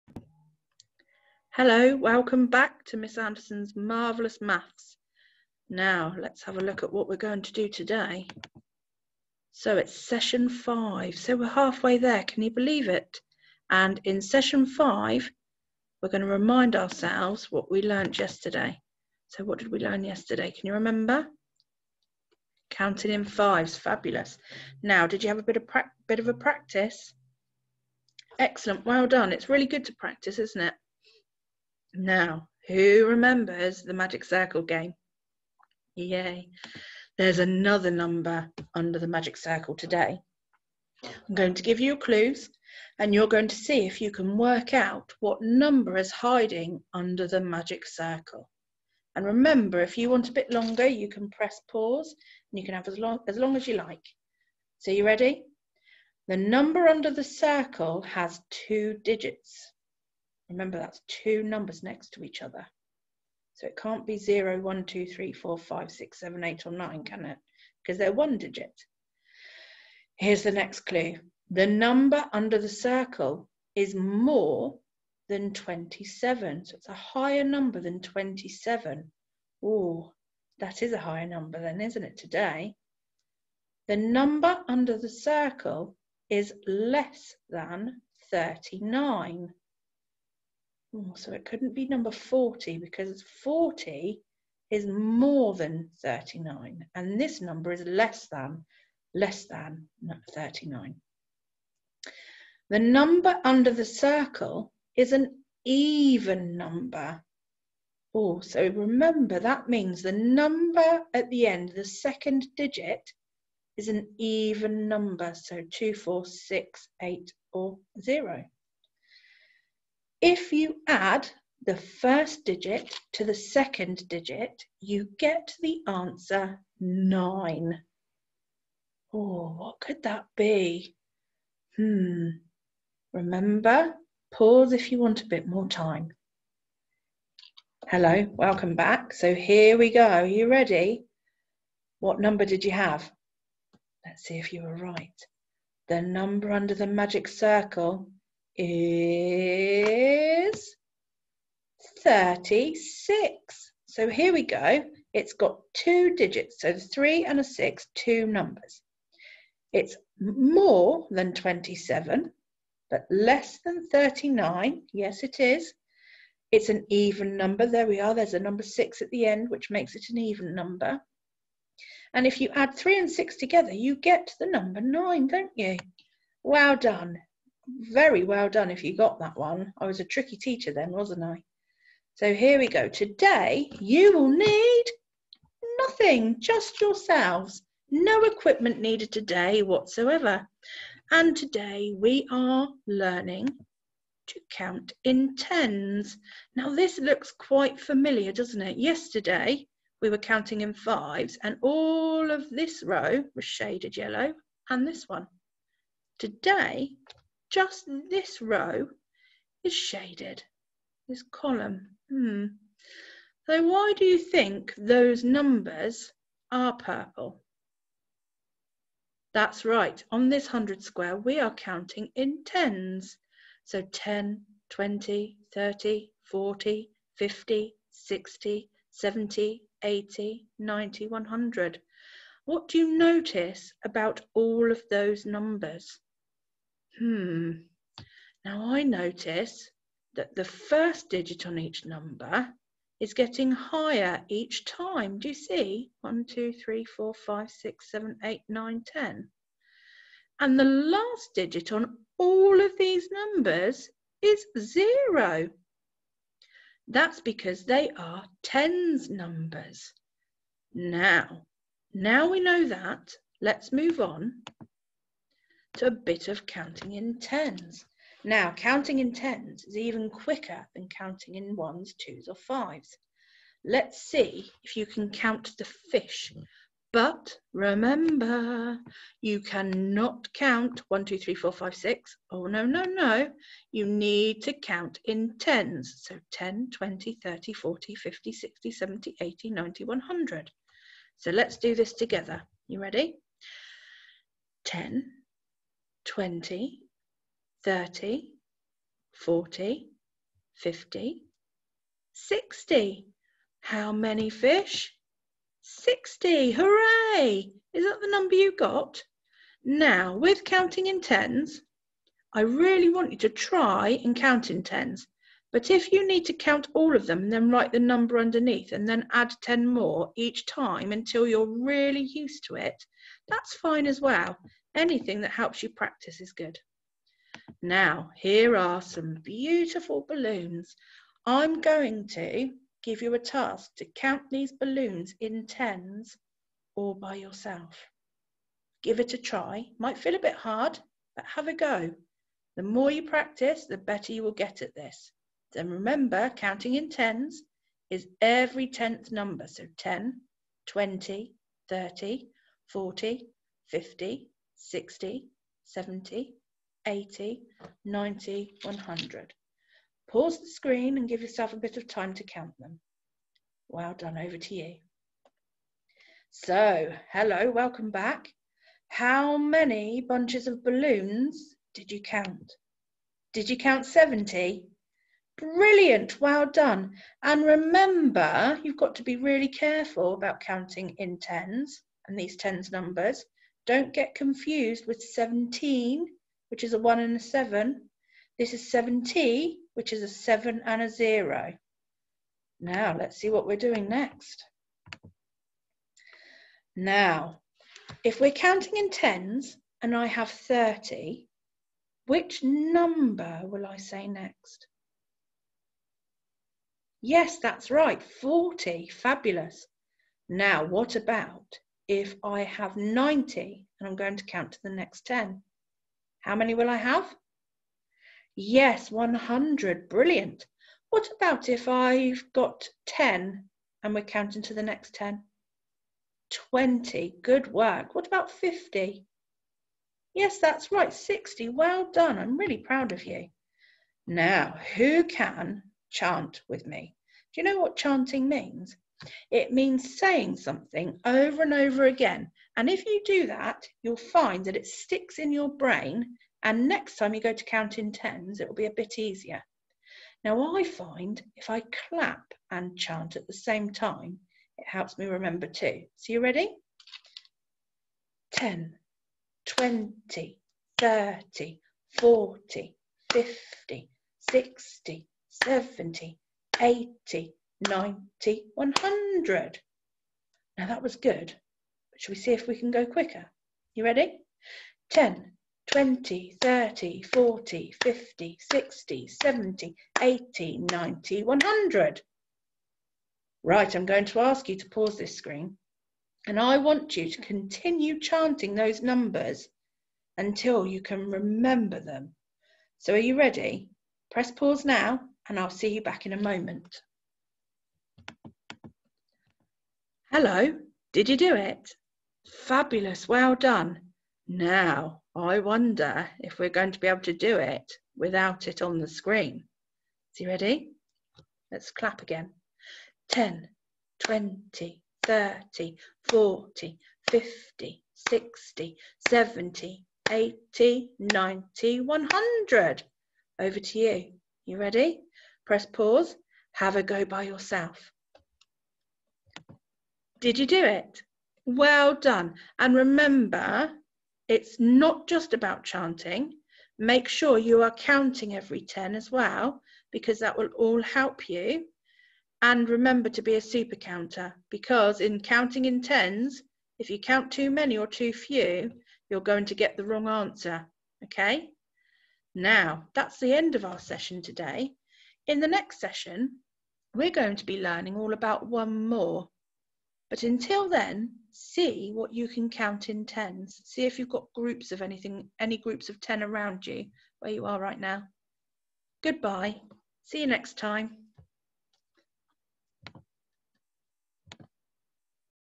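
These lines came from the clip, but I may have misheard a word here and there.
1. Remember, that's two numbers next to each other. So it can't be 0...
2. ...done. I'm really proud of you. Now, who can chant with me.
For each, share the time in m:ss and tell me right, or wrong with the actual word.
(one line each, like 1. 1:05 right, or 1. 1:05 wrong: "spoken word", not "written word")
1. 1:00 right
2. 7:11 right.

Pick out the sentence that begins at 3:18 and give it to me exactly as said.
Yesterday we were counting in fives and all of this row was shaded yellow and this one.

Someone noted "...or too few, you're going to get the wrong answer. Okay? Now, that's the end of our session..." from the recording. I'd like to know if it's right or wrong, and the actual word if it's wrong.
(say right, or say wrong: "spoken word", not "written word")
right.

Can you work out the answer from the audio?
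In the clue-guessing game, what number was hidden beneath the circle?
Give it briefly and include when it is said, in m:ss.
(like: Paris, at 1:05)
36, at 2:32.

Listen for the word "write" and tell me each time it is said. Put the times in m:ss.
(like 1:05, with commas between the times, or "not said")
5:17.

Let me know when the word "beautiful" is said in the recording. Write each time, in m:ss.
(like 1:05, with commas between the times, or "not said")
5:29.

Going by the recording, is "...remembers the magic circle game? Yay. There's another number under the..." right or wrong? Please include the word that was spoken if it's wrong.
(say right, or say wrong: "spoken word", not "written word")
right.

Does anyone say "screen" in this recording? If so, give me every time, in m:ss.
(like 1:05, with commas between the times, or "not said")
6:00, 8:05, 8:28.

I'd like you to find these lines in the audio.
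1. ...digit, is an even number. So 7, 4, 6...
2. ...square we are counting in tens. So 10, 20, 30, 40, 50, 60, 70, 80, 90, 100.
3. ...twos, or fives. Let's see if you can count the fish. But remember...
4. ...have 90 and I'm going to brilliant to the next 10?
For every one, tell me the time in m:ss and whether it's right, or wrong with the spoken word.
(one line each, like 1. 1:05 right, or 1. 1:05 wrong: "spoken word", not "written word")
1. 1:52 wrong: "2", not "7"
2. 3:40 right
3. 4:31 right
4. 6:52 wrong: "count", not "brilliant".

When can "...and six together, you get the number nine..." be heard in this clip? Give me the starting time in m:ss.
2:52.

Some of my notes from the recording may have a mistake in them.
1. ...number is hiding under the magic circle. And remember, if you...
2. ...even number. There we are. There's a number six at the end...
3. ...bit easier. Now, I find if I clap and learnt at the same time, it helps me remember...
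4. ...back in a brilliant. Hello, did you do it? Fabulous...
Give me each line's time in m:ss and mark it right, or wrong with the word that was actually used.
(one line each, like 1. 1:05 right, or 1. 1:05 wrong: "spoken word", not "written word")
1. 0:45 right
2. 2:46 right
3. 7:28 wrong: "chant", not "learnt"
4. 8:15 wrong: "moment", not "brilliant".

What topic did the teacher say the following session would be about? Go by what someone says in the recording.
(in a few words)
one more.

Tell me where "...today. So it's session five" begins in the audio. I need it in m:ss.
0:07.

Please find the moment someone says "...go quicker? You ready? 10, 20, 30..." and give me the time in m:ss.
7:52.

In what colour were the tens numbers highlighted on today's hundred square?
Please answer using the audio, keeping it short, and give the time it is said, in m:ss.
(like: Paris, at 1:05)
purple, at 3:36.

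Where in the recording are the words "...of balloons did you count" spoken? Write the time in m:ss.
6:10.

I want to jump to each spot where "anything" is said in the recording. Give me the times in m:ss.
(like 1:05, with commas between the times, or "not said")
5:24, 9:24.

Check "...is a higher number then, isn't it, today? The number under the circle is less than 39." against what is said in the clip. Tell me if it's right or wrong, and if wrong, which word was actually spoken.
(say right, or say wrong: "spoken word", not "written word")
right.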